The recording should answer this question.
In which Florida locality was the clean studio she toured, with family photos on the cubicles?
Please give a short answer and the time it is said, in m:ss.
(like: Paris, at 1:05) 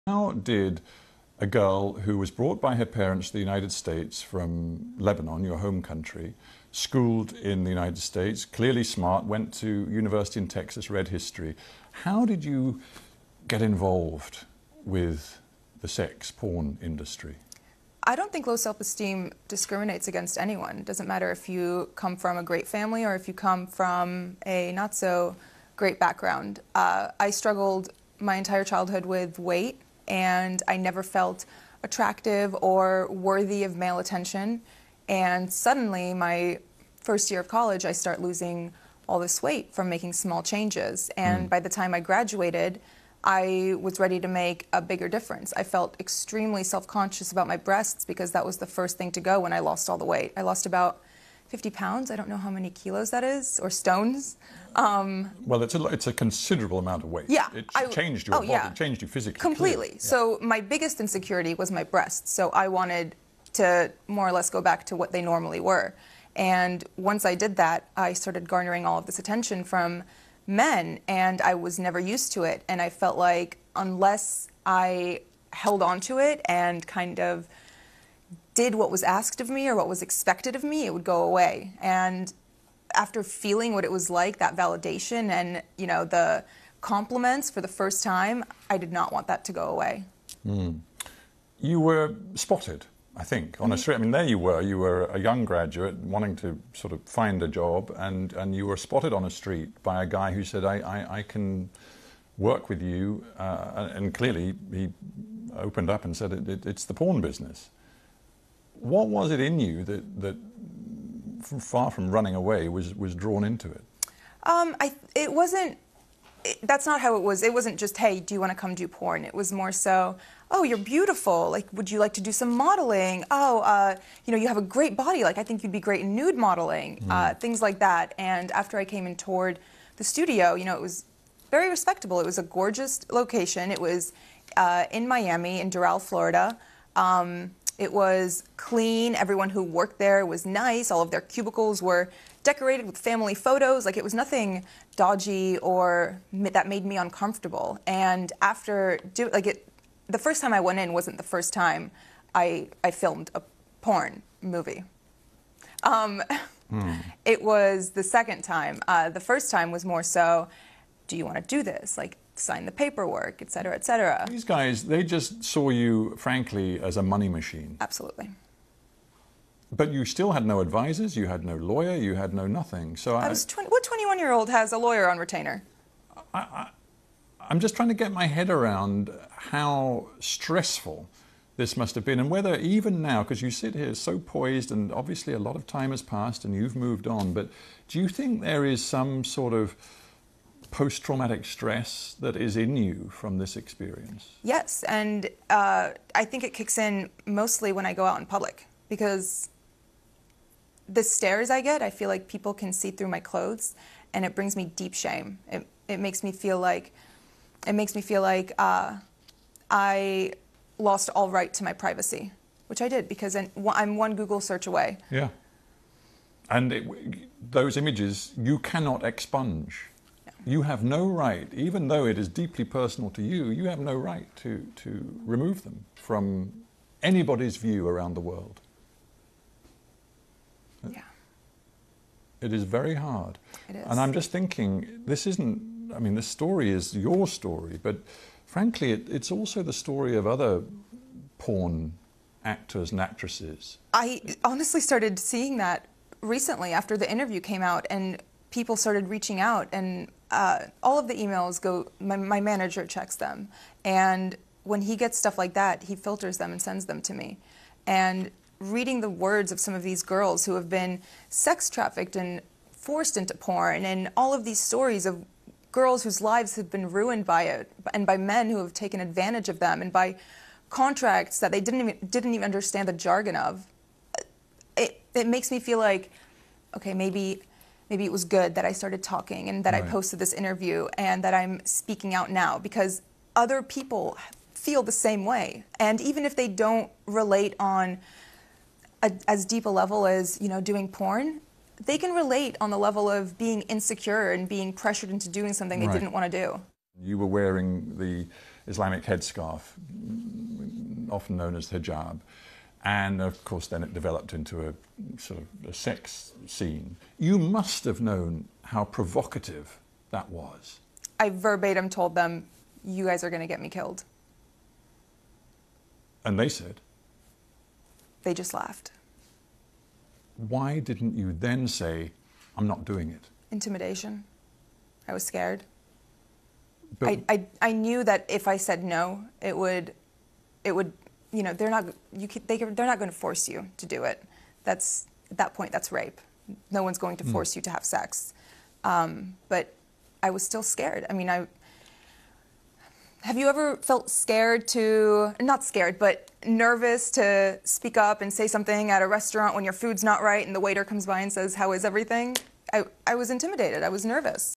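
Doral, at 2:15.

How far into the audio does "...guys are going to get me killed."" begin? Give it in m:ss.
5:13.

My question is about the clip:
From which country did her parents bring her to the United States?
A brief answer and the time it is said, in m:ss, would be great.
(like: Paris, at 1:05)
Lebanon, at 0:04.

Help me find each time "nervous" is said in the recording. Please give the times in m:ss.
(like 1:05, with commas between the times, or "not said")
5:46, 5:54.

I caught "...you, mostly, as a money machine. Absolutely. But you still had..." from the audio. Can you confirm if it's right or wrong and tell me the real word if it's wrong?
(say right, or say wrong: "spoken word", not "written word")
wrong: "frankly", not "mostly".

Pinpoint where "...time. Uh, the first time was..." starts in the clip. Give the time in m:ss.
2:38.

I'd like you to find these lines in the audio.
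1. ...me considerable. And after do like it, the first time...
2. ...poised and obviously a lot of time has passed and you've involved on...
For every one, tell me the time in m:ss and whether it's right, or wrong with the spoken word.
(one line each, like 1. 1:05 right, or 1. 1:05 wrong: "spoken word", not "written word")
1. 2:26 wrong: "uncomfortable", not "considerable"
2. 3:04 wrong: "moved", not "involved".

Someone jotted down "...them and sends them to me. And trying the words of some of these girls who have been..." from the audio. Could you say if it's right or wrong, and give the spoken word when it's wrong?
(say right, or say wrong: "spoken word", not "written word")
wrong: "reading", not "trying".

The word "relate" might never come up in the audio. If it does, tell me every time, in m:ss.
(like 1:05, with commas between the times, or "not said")
4:47, 4:52.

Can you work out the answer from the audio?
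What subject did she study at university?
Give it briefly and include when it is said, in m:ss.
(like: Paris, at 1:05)
History, at 0:11.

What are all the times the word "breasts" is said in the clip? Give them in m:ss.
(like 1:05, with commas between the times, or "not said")
0:47, 1:01.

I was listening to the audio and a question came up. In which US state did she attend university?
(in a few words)
Texas.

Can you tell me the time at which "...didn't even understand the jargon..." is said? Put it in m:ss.
4:32.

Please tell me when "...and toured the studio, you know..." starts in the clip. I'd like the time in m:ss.
2:09.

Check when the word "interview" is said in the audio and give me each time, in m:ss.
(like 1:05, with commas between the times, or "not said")
4:07, 4:40.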